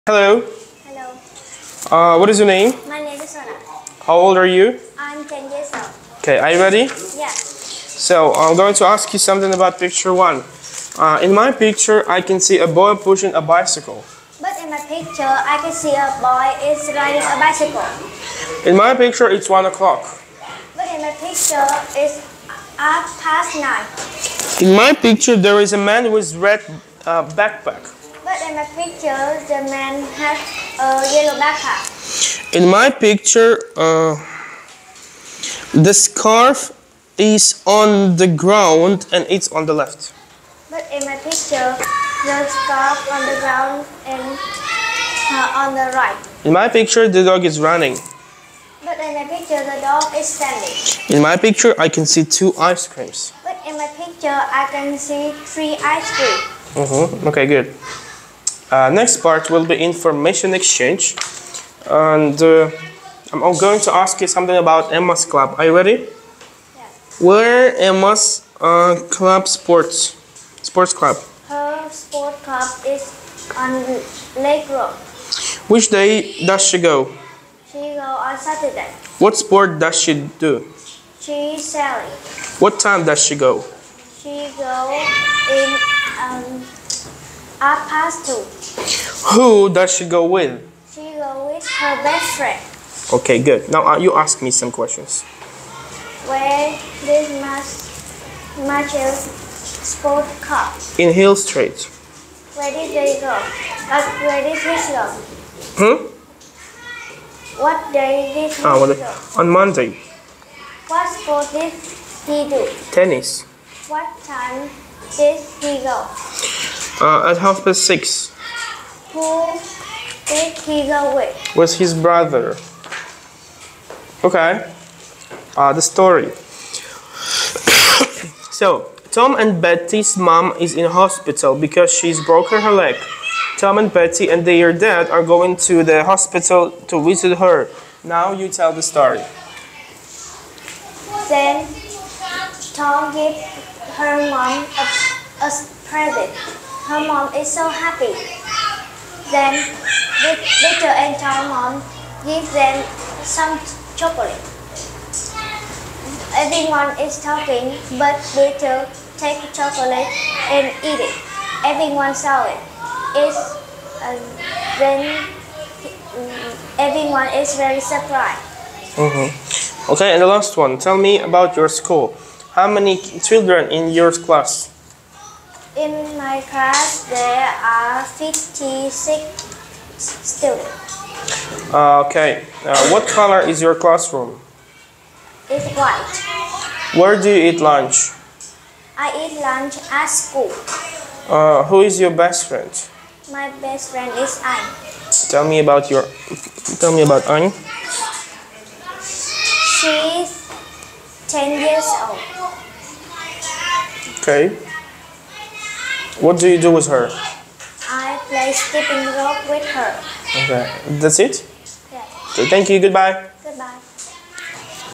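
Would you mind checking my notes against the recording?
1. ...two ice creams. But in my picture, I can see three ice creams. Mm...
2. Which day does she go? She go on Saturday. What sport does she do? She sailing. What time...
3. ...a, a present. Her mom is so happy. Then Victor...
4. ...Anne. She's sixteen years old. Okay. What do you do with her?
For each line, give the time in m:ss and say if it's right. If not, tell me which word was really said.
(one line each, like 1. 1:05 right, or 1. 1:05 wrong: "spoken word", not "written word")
1. 0:52 right
2. 1:15 right
3. 2:24 right
4. 3:17 wrong: "ten", not "sixteen".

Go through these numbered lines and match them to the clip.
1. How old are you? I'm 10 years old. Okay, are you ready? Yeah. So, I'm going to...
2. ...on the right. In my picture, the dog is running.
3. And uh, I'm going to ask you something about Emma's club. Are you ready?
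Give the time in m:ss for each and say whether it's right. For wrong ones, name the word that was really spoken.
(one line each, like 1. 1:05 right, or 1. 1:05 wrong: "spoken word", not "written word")
1. 0:04 right
2. 0:45 right
3. 1:01 right.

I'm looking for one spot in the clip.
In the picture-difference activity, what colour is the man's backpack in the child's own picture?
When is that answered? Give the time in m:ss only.
0:31.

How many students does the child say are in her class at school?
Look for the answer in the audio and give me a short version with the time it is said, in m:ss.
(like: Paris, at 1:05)
56, at 2:58.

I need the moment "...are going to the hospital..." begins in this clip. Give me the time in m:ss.
2:15.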